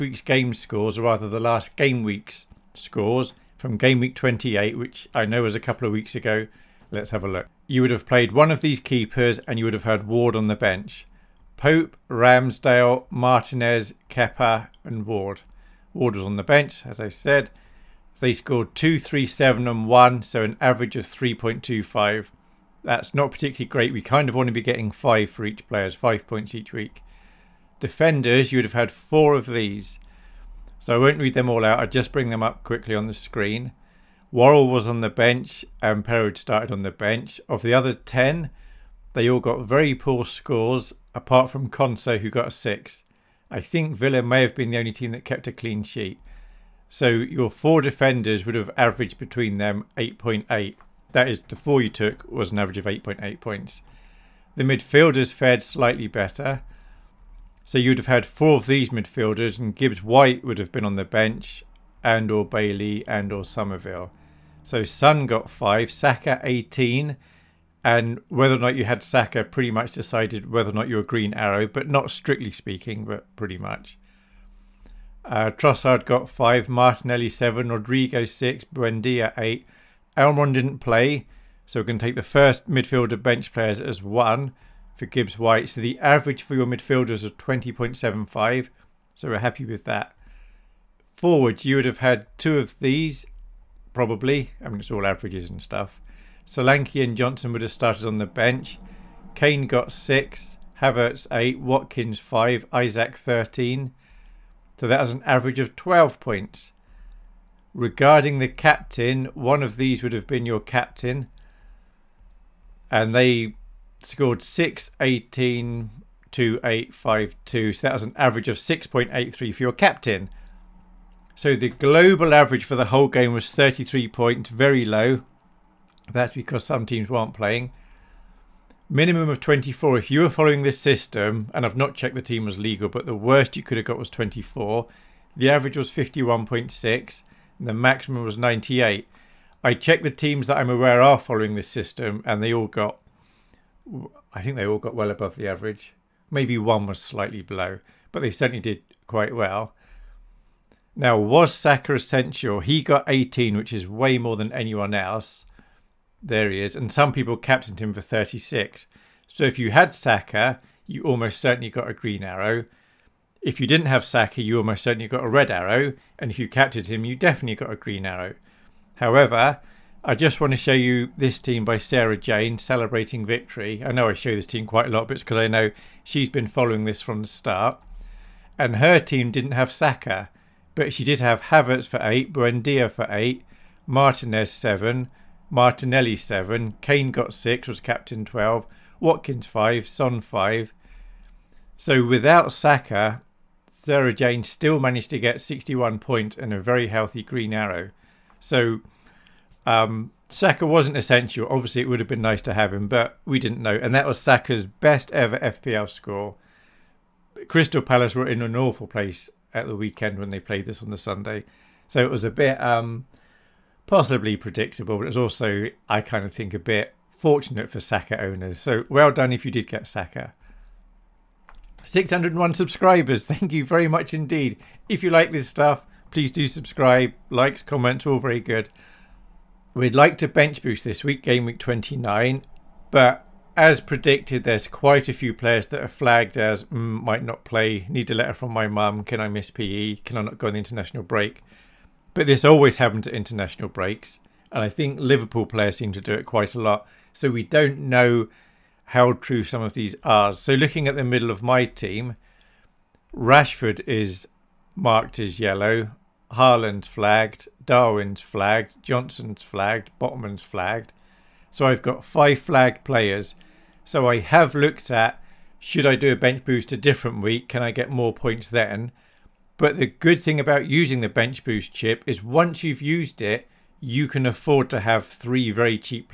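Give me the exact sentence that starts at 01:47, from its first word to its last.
Regarding the captain, one of these would have been your captain.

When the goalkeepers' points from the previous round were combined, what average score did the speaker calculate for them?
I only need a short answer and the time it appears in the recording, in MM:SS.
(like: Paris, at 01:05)
3.25, at 00:21.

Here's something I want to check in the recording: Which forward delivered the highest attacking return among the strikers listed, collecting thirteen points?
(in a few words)
Isak.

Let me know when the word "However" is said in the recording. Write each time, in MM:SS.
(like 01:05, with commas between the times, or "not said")
02:48.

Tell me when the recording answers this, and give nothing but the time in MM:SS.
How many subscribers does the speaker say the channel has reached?
03:41.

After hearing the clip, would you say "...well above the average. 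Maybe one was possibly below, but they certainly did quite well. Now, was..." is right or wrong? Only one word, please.
wrong.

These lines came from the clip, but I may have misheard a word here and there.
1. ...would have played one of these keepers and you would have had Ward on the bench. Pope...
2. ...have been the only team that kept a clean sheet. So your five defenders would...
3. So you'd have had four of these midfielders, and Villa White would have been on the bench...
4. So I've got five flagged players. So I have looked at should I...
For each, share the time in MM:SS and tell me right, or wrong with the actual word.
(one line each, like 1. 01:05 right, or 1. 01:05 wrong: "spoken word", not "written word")
1. 00:07 right
2. 00:44 wrong: "four", not "five"
3. 00:57 wrong: "Gibbs", not "Villa"
4. 04:21 right.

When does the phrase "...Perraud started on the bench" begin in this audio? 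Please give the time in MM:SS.
00:36.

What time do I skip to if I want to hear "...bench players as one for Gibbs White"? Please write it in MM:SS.
01:23.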